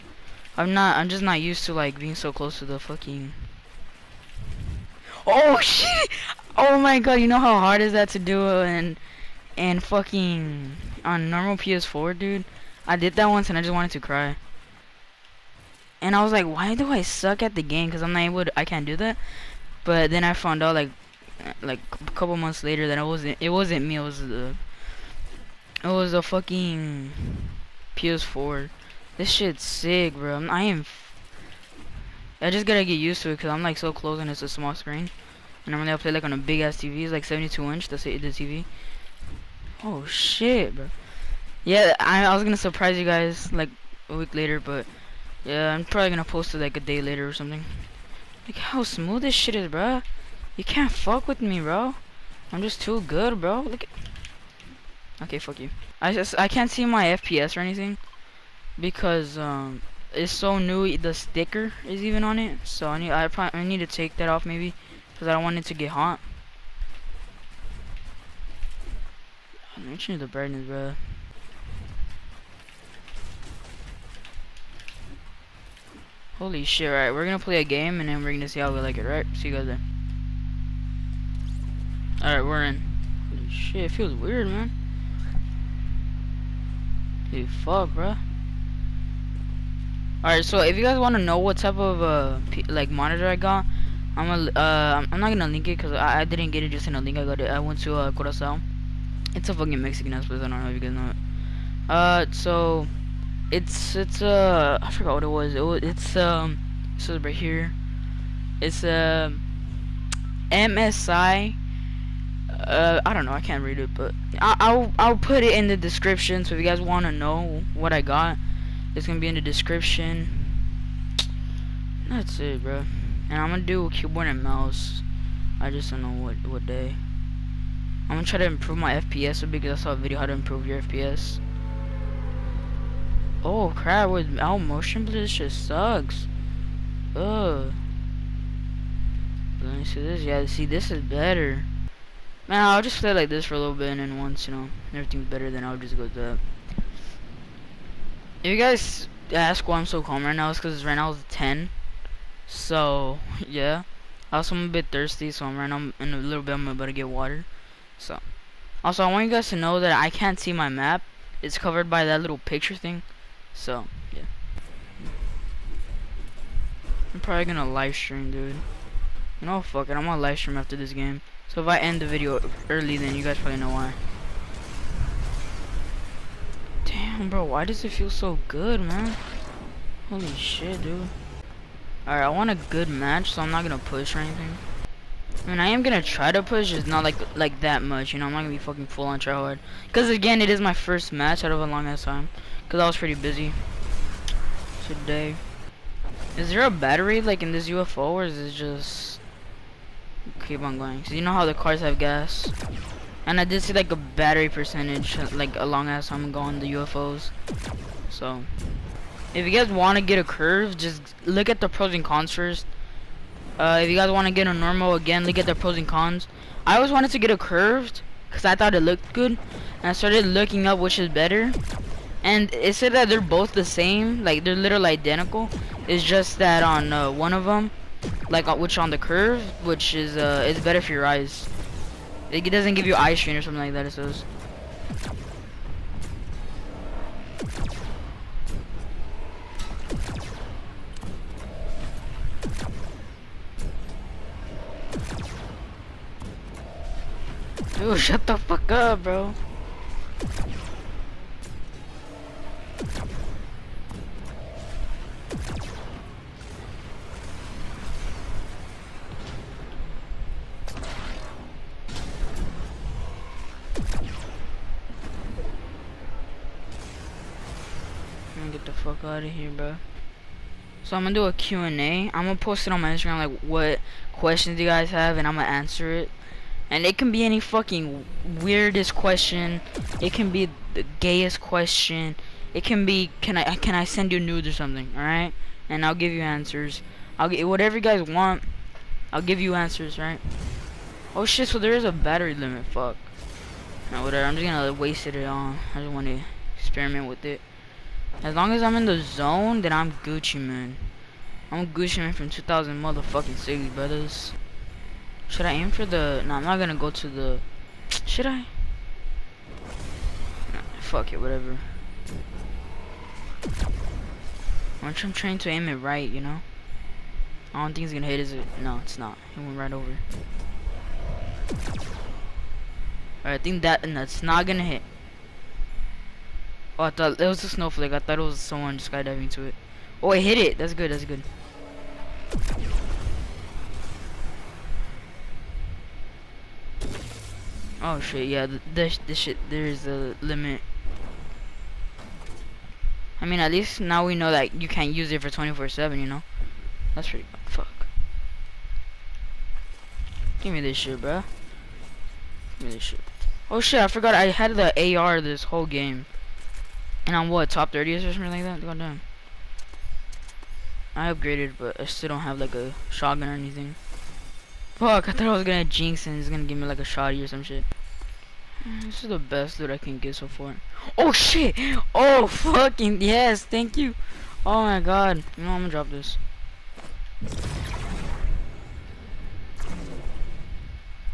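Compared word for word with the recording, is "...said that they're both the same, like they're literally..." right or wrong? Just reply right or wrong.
right.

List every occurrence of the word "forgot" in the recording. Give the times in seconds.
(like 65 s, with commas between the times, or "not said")
104 s, 353 s.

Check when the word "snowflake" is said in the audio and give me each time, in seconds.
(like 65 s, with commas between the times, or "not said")
327 s.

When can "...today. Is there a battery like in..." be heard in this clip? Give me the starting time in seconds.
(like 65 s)
194 s.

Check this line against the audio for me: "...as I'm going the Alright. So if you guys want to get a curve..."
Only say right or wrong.
wrong.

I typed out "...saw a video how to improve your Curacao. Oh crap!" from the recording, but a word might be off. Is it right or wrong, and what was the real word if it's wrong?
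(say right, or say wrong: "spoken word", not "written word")
wrong: "FPS", not "Curacao".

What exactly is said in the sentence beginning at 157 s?
So, also, I want you guys to know that I can't see my map.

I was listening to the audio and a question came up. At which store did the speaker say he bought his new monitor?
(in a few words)
Curacao.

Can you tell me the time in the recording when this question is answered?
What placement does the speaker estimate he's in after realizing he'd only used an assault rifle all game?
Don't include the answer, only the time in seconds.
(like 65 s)
357 s.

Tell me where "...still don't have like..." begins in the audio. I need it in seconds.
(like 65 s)
361 s.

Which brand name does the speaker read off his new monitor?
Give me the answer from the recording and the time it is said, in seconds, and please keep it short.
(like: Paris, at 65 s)
MSI, at 110 s.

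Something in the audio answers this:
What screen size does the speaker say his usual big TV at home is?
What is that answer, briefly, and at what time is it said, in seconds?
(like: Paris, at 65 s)
72 inch, at 37 s.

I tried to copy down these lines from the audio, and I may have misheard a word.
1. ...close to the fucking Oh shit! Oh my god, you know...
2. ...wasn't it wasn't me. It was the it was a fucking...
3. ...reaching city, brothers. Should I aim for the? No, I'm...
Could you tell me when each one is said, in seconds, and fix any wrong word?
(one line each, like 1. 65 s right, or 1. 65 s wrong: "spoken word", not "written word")
1. 2 s right
2. 23 s right
3. 302 s wrong: "motherfucking", not "reaching".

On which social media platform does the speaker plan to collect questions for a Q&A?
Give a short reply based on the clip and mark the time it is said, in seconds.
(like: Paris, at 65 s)
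Instagram, at 272 s.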